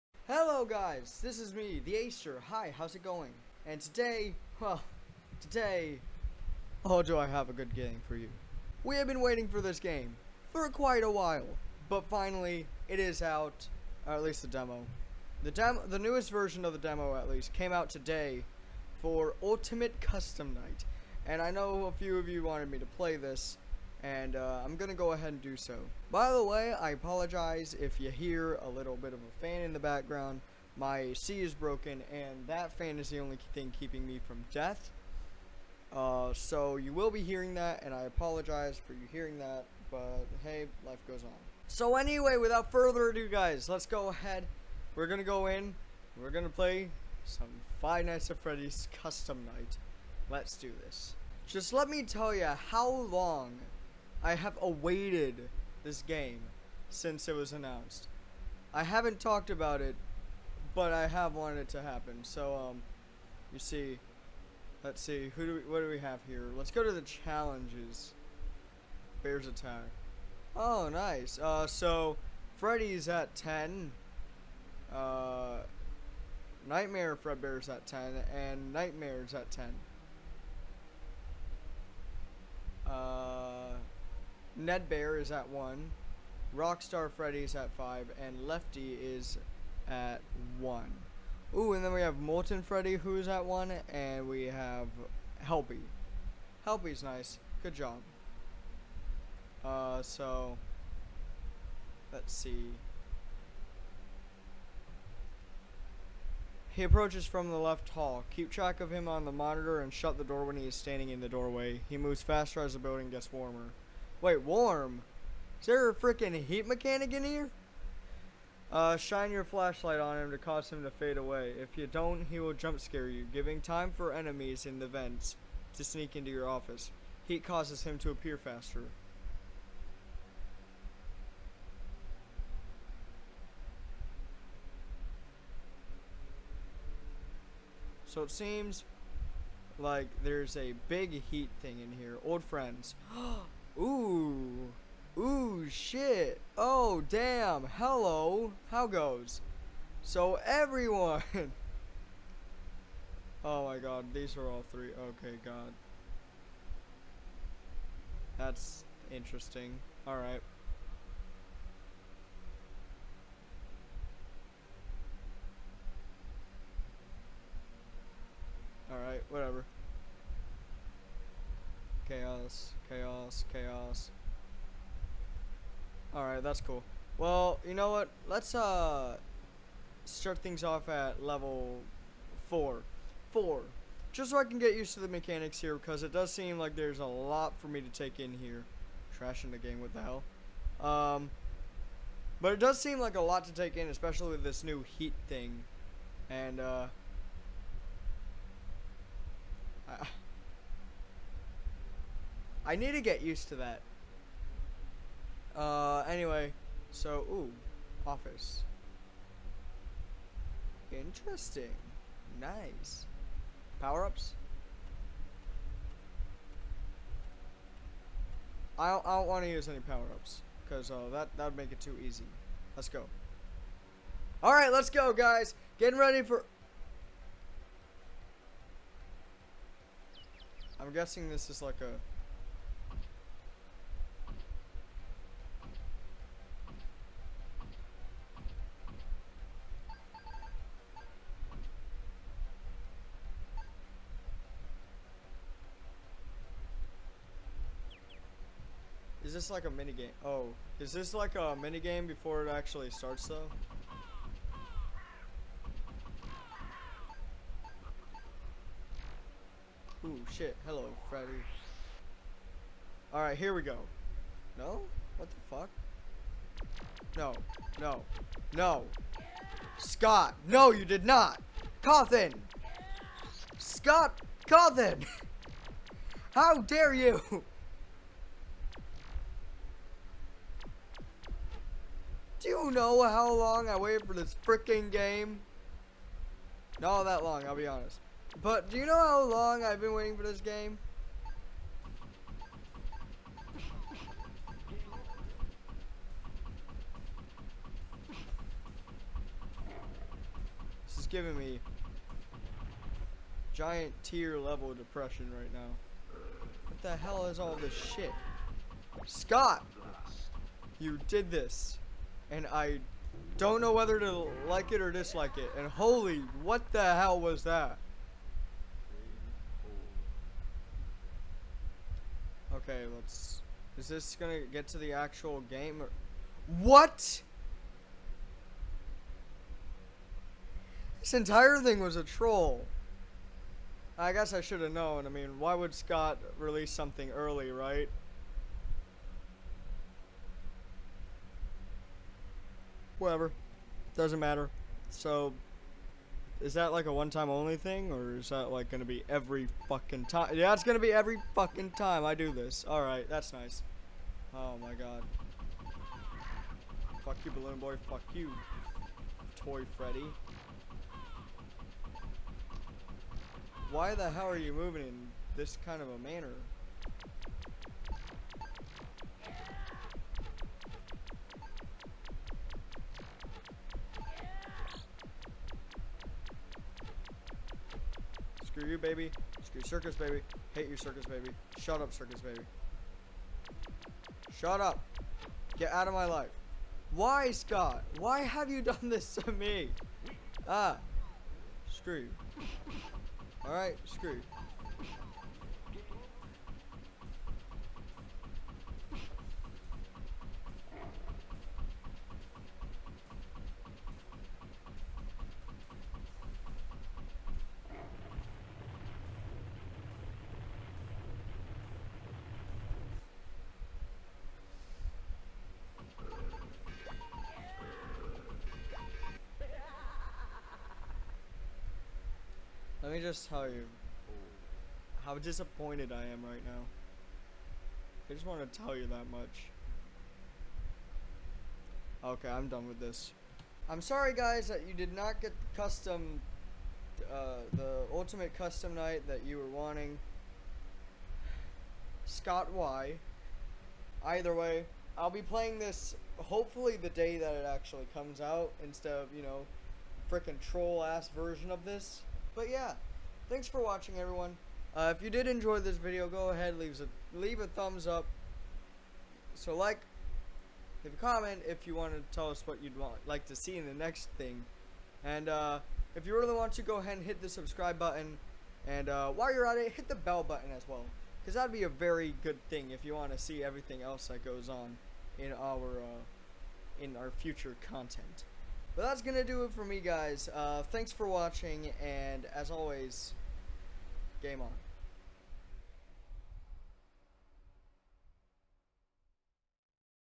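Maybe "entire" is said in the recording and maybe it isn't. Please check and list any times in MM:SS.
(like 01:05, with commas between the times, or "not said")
05:31.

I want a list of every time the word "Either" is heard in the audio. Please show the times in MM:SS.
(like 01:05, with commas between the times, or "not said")
07:24.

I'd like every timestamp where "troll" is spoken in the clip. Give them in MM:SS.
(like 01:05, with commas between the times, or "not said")
05:32, 07:30.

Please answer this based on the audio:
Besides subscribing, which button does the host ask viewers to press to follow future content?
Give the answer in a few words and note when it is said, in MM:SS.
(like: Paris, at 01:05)
Bell button, at 07:49.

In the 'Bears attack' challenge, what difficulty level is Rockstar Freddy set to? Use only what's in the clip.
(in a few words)
5.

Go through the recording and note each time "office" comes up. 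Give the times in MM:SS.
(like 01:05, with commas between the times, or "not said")
02:06, 03:28.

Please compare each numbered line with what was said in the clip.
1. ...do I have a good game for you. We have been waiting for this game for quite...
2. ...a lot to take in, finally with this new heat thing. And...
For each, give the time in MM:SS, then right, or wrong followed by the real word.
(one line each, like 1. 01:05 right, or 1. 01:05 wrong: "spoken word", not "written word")
1. 00:07 right
2. 03:13 wrong: "especially", not "finally".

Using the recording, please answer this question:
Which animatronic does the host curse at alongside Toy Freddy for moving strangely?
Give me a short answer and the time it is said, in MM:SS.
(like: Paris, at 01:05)
Balloon Boy, at 05:57.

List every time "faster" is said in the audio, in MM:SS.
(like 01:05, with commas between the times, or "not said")
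01:52, 02:08.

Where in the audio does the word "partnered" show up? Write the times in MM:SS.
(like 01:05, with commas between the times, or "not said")
not said.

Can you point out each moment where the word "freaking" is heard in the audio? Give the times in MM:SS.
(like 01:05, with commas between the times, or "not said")
01:55, 04:44, 07:30.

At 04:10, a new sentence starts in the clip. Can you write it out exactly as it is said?
Oh, is this like a mini game before it actually starts though?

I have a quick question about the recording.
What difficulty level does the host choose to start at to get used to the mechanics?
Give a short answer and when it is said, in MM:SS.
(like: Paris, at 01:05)
4, at 03:01.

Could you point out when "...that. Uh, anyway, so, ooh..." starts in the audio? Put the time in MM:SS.
03:23.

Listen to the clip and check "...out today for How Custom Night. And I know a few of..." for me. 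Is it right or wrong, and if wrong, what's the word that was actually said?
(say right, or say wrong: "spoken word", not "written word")
wrong: "Ultimate", not "How".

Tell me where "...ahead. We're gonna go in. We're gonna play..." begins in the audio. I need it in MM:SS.
00:44.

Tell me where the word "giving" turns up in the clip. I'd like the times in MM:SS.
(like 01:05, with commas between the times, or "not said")
02:03, 05:01.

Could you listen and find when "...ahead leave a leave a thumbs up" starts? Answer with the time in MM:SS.
07:36.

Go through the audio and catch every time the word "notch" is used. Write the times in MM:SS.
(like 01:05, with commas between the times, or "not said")
not said.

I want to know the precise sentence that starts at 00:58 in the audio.
I haven't talked about it but I have wanted it to happen.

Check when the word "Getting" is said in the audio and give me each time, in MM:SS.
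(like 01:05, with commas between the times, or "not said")
03:45.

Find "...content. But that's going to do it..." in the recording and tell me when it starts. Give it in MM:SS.
07:57.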